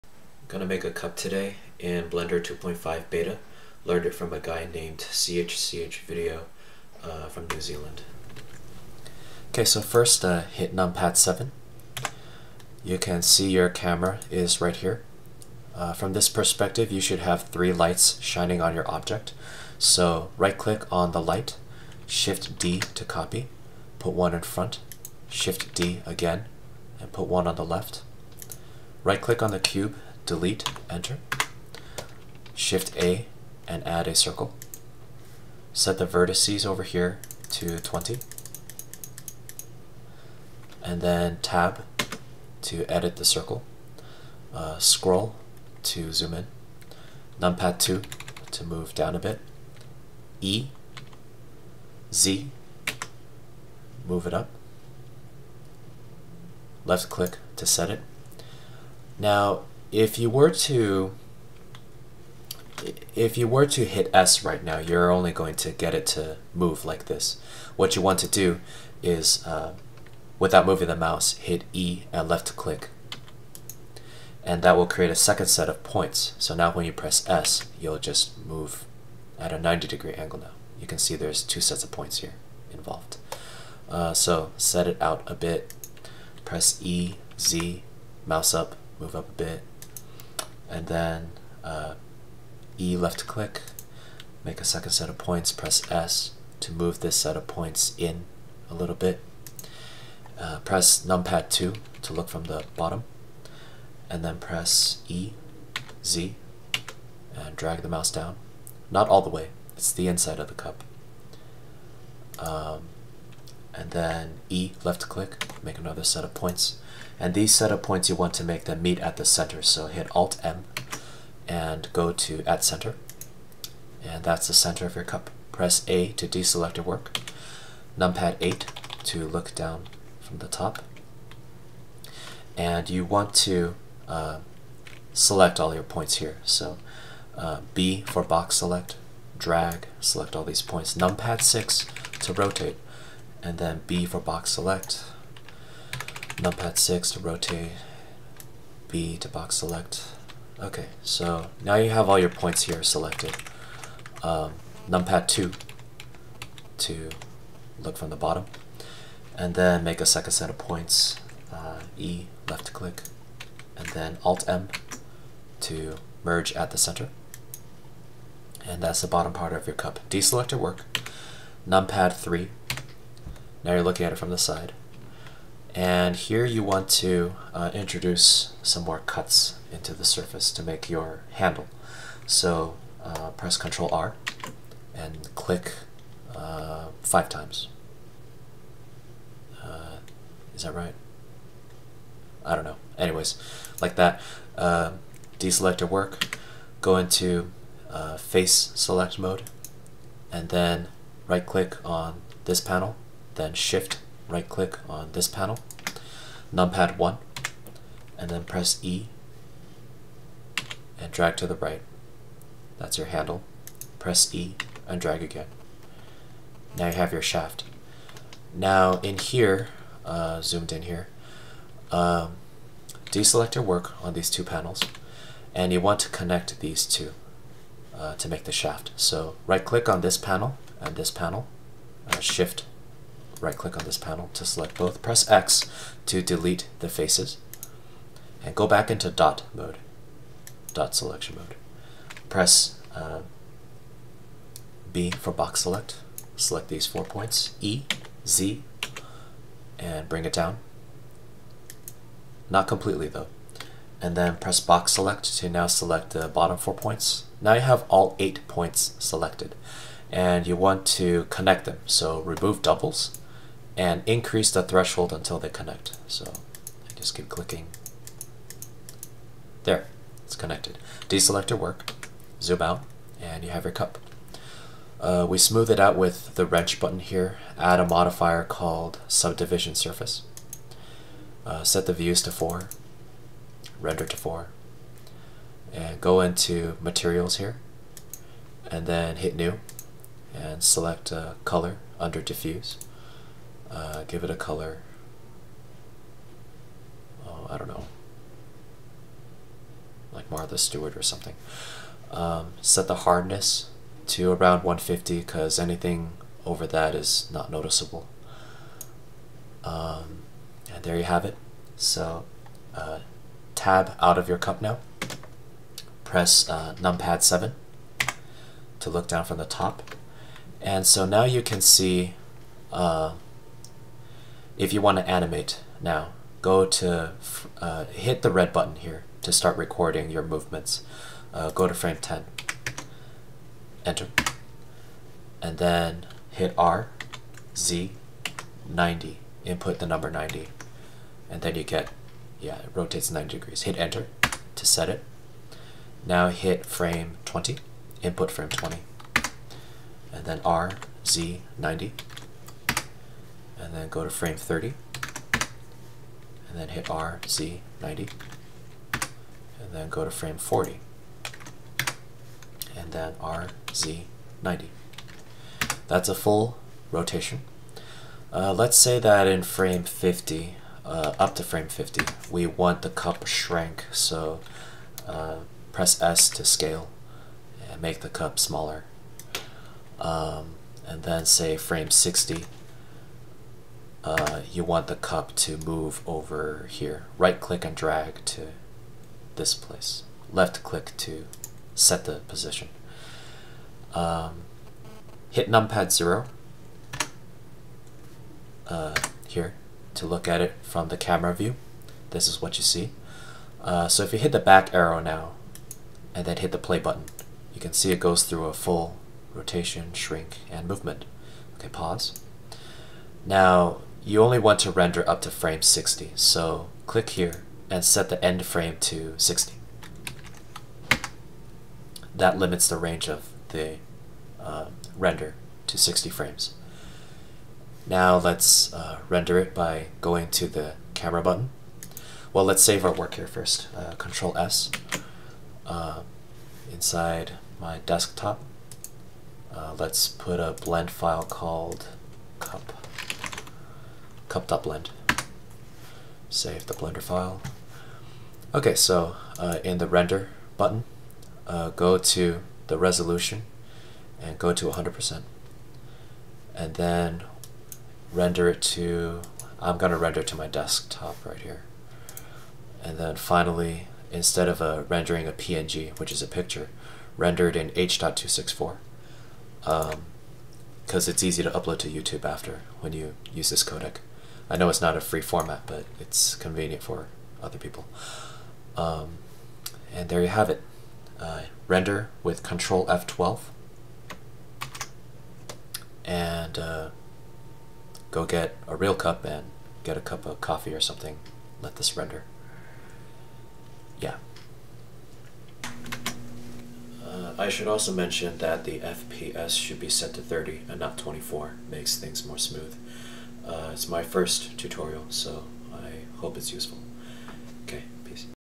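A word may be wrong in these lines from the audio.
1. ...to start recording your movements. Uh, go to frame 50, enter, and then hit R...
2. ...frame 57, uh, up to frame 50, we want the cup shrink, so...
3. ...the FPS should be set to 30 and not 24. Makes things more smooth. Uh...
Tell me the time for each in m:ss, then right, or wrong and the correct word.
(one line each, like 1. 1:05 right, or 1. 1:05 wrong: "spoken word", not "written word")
1. 5:29 wrong: "10", not "50"
2. 6:09 wrong: "50", not "57"
3. 8:18 right.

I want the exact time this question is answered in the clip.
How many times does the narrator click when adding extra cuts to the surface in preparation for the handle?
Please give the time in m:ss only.
3:07.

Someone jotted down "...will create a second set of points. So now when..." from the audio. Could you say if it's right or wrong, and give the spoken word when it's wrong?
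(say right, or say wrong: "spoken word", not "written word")
right.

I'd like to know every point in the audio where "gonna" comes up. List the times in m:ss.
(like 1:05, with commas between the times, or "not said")
0:00, 7:39.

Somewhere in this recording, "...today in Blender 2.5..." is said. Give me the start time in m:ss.
0:01.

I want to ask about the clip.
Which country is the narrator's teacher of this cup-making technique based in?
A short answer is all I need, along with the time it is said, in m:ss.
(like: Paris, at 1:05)
New Zealand, at 0:07.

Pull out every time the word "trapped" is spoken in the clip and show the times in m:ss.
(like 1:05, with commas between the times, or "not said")
not said.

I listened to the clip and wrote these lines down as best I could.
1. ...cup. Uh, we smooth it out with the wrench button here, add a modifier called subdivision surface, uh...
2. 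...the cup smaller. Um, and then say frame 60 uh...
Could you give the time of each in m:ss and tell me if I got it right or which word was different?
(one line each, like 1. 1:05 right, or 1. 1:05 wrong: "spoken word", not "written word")
1. 4:33 right
2. 6:18 right.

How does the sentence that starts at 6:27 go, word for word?
Right click and drag to this place.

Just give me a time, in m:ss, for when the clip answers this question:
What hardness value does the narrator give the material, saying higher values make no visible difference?
5:04.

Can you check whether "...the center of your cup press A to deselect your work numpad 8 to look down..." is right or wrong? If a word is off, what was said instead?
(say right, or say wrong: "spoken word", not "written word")
right.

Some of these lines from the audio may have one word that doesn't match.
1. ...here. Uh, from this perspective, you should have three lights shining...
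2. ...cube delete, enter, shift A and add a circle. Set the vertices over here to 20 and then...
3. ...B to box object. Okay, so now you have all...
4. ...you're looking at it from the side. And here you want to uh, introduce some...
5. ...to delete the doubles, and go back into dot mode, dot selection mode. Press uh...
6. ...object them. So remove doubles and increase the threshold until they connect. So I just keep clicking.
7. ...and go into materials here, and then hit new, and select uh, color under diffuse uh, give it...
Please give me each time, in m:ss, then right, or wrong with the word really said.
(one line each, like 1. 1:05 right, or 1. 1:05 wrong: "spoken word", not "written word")
1. 0:14 right
2. 0:29 right
3. 2:28 wrong: "select", not "object"
4. 2:53 right
5. 3:56 wrong: "faces", not "doubles"
6. 4:21 wrong: "connect", not "object"
7. 4:45 right.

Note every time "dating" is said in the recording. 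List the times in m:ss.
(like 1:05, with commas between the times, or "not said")
not said.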